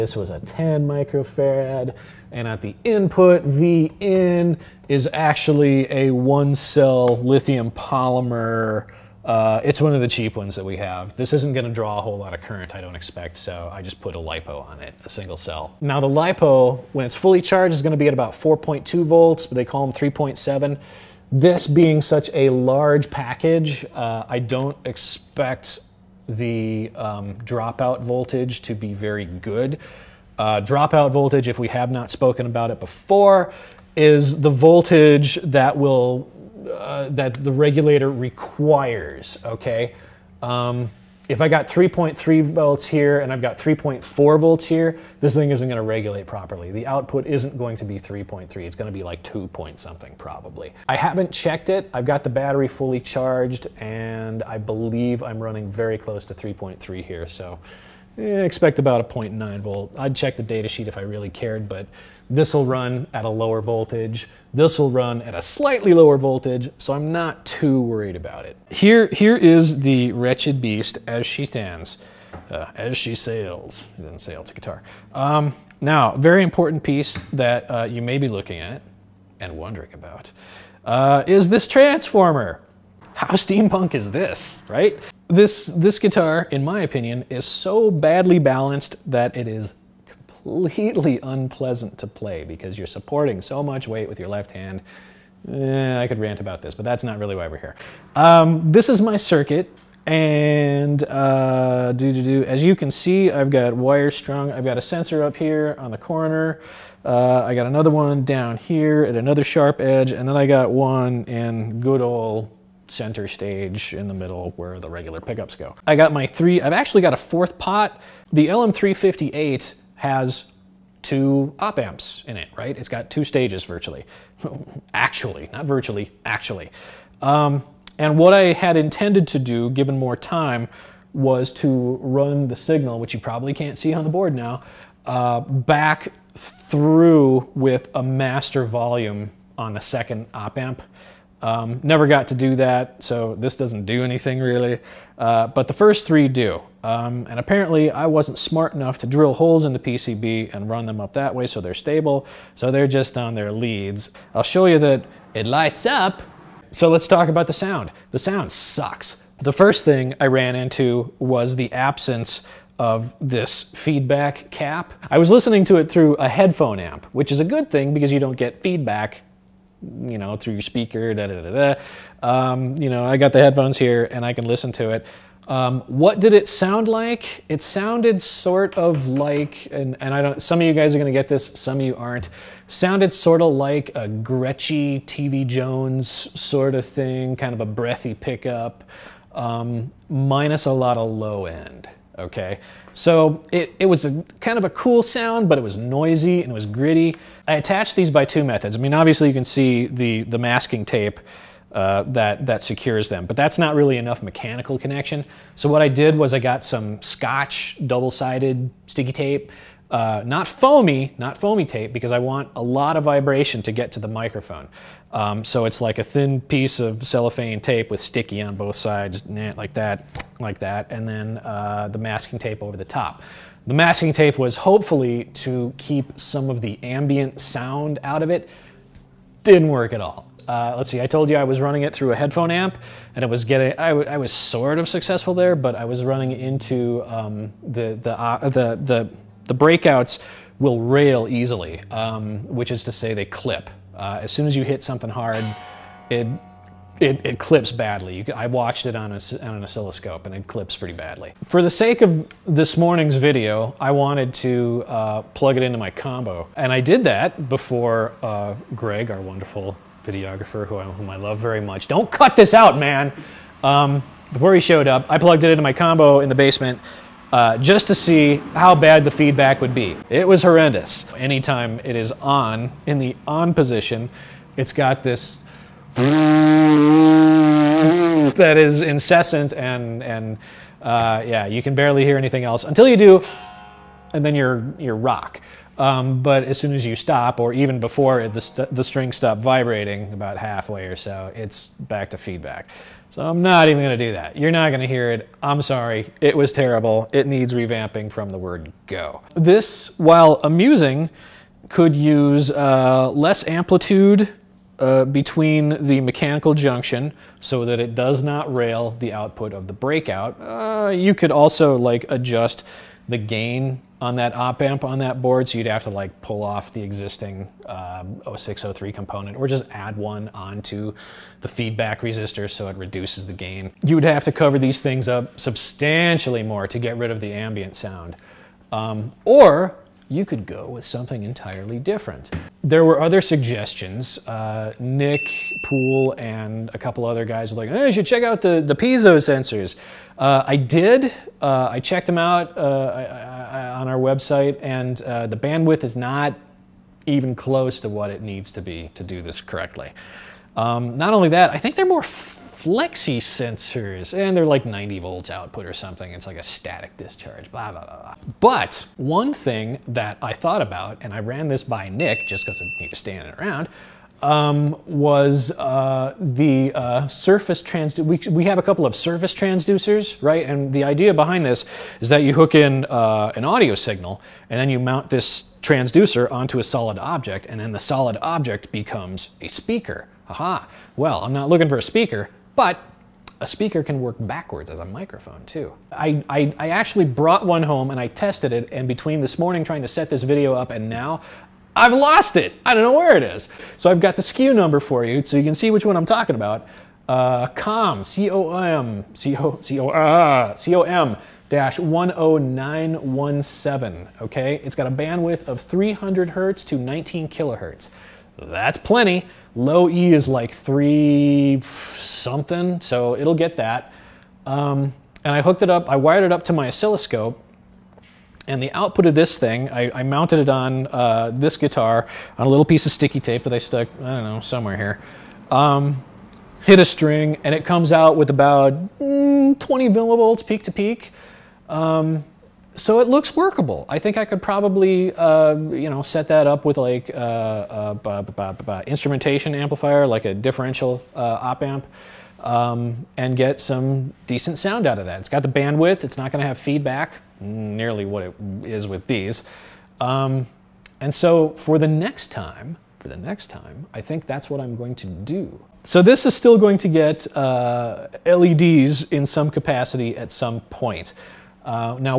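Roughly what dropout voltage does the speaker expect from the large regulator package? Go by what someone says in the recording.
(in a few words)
0.9 volt.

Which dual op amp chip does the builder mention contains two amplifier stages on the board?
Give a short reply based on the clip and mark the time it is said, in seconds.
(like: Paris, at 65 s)
LM358, at 118 s.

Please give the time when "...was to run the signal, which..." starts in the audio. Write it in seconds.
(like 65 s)
131 s.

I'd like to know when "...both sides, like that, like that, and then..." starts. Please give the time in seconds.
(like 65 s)
218 s.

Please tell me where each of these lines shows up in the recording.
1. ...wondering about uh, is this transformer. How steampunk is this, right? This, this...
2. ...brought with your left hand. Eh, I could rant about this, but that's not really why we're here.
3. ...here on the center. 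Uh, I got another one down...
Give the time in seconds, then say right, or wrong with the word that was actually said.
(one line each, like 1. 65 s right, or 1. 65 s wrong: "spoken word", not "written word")
1. 79 s right
2. 93 s wrong: "weight", not "brought"
3. 105 s wrong: "corner", not "center".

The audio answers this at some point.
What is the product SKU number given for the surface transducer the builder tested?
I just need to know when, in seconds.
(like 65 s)
401 s.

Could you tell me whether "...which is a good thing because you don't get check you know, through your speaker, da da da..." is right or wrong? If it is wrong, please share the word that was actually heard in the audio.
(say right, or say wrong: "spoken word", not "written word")
wrong: "feedback", not "check".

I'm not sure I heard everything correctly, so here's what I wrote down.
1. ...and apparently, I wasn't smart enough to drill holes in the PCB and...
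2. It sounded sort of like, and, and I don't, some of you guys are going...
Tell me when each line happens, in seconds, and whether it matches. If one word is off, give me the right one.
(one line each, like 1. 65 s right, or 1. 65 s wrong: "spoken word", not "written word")
1. 147 s right
2. 177 s right.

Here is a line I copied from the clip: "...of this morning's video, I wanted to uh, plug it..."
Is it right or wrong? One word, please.
right.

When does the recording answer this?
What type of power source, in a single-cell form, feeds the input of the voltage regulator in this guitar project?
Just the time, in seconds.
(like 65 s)
7 s.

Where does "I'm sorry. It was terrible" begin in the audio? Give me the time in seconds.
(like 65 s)
295 s.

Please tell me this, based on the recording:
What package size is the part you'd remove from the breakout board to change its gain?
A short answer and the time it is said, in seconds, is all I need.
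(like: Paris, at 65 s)
0603, at 318 s.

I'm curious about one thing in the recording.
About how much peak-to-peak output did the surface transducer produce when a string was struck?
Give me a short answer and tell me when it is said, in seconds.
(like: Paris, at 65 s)
20 millivolts, at 429 s.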